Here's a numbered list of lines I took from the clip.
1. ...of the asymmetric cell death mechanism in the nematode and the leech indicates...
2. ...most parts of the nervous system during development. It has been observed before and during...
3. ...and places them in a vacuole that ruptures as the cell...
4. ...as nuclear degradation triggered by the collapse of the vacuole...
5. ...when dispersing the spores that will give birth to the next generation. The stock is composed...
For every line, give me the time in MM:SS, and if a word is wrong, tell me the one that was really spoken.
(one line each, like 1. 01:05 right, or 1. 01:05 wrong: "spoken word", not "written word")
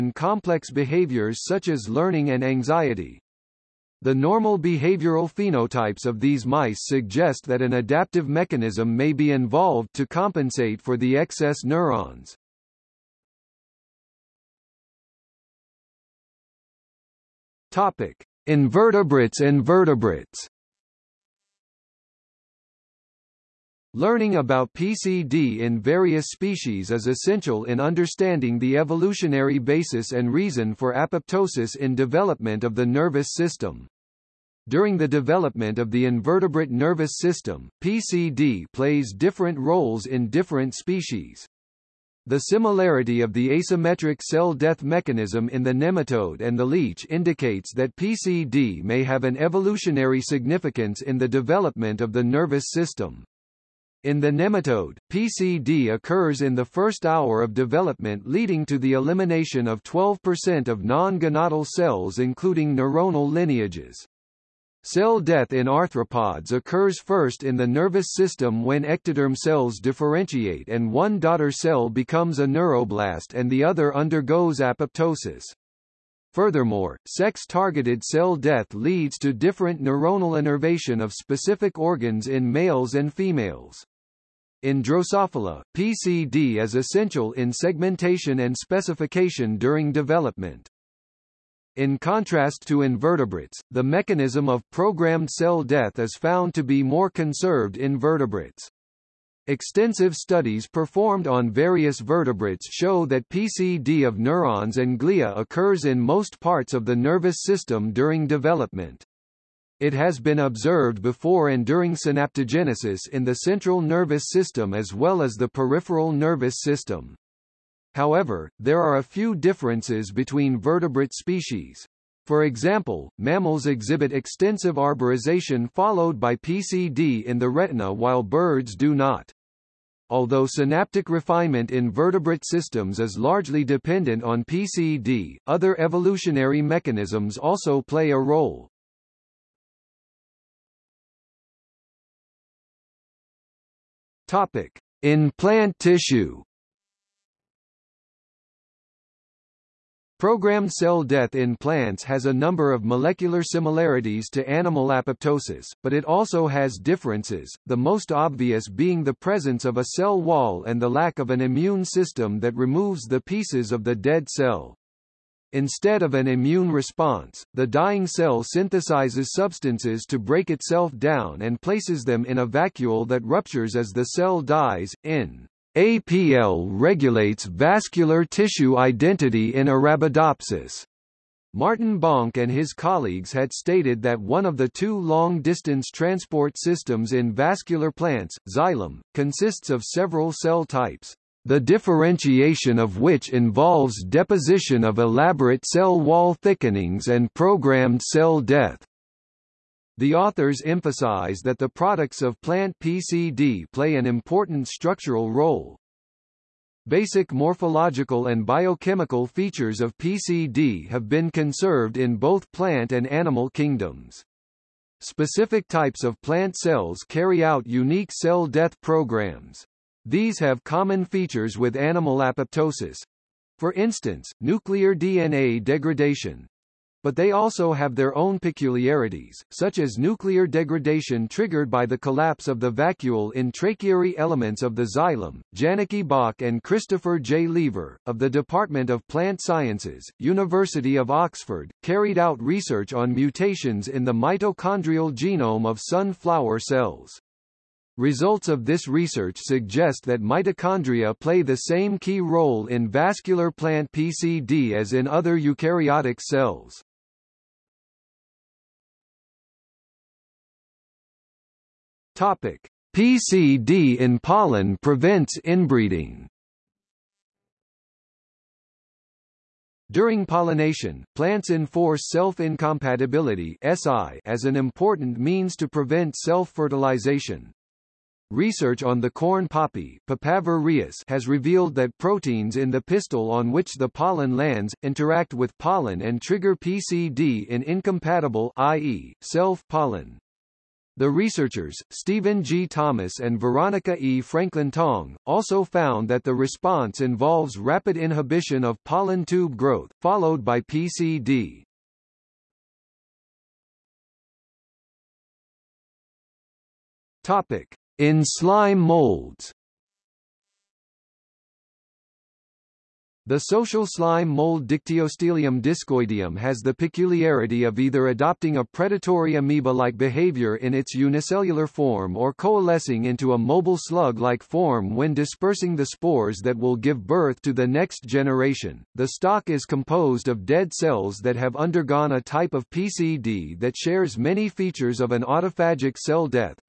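1. 00:43 right
2. 01:45 right
3. 02:51 right
4. 03:49 right
5. 05:24 right.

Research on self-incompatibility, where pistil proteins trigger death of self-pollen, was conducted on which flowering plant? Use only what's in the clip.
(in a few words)
corn poppy.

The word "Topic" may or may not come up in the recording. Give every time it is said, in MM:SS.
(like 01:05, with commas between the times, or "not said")
00:17, 02:24, 04:22, 05:07.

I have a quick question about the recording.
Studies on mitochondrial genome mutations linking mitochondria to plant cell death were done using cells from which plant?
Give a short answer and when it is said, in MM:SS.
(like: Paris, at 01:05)
sunflower, at 04:05.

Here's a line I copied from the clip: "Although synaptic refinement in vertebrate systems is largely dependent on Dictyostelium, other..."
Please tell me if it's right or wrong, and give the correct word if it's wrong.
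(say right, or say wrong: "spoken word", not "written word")
wrong: "PCD", not "Dictyostelium".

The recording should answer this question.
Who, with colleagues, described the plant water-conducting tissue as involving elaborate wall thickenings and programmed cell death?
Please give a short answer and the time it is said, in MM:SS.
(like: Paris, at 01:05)
Martin Bonke, at 03:01.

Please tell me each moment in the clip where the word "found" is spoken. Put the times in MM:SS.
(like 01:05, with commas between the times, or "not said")
01:36, 04:55.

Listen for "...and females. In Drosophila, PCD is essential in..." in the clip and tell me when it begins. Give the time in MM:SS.
01:22.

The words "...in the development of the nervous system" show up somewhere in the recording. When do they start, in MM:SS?
00:51.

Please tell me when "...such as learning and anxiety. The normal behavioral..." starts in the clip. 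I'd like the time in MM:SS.
00:01.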